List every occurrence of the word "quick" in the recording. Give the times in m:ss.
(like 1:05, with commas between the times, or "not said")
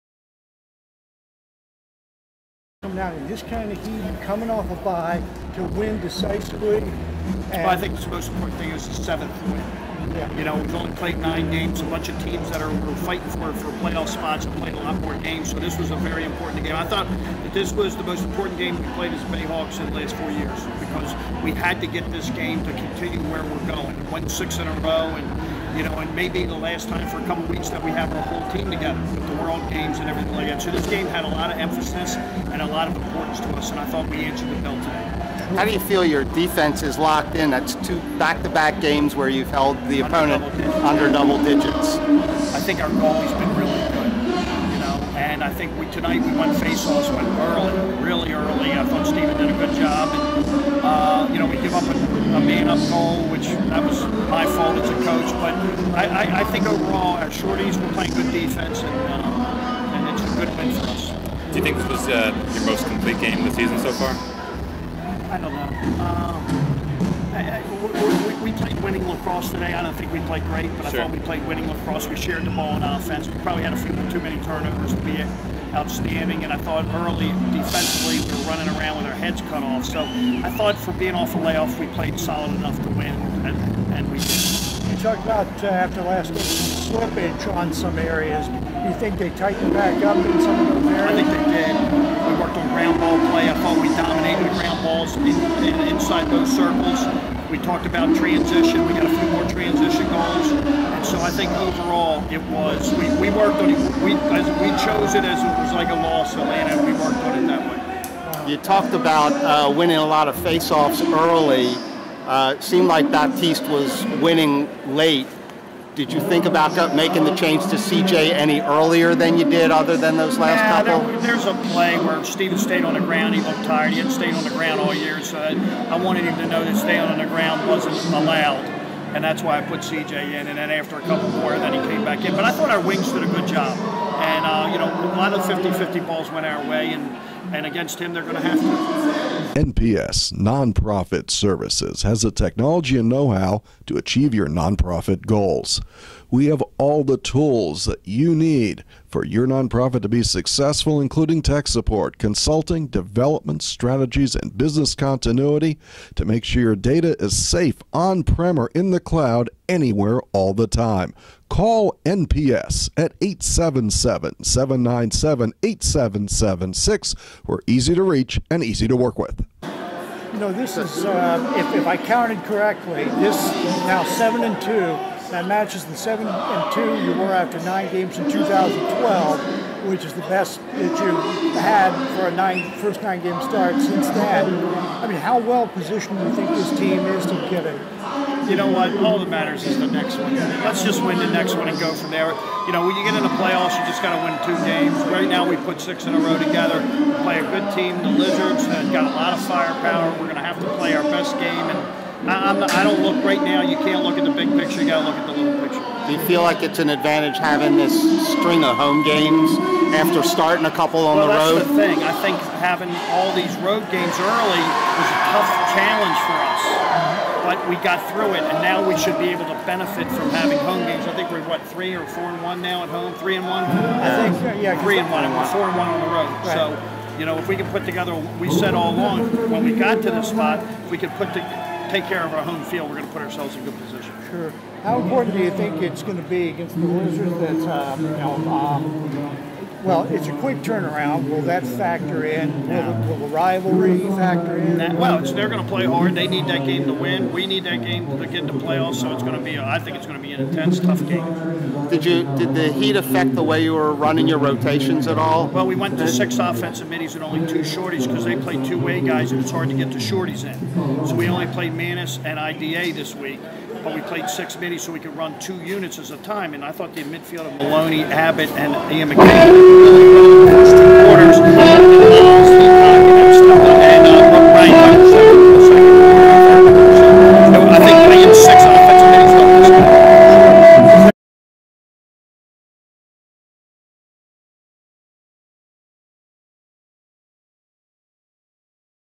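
4:00.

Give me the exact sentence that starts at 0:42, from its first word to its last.
I think our goalie's been really good, you know, and I think we tonight we went face-offs, went early, really early.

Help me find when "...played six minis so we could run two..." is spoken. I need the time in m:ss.
4:24.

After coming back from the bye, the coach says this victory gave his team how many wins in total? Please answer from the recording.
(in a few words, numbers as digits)
7.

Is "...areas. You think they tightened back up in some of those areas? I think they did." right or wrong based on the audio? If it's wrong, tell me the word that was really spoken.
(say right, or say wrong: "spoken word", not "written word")
right.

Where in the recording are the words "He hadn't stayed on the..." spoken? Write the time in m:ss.
2:03.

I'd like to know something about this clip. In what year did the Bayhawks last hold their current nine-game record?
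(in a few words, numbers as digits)
2012.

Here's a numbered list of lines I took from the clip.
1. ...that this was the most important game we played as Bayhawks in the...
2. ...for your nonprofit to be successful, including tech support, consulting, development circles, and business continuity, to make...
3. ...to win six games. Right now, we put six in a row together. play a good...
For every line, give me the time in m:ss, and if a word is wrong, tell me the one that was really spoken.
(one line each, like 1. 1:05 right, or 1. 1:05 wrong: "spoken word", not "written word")
1. 0:17 right
2. 2:29 wrong: "strategies", not "circles"
3. 3:14 wrong: "two", not "six".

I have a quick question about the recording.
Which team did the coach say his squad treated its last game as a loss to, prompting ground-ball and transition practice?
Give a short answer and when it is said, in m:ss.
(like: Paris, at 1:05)
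Atlanta, at 1:46.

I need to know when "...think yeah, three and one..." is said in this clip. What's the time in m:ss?
3:44.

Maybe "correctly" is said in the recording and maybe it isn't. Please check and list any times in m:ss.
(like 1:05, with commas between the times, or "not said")
2:52.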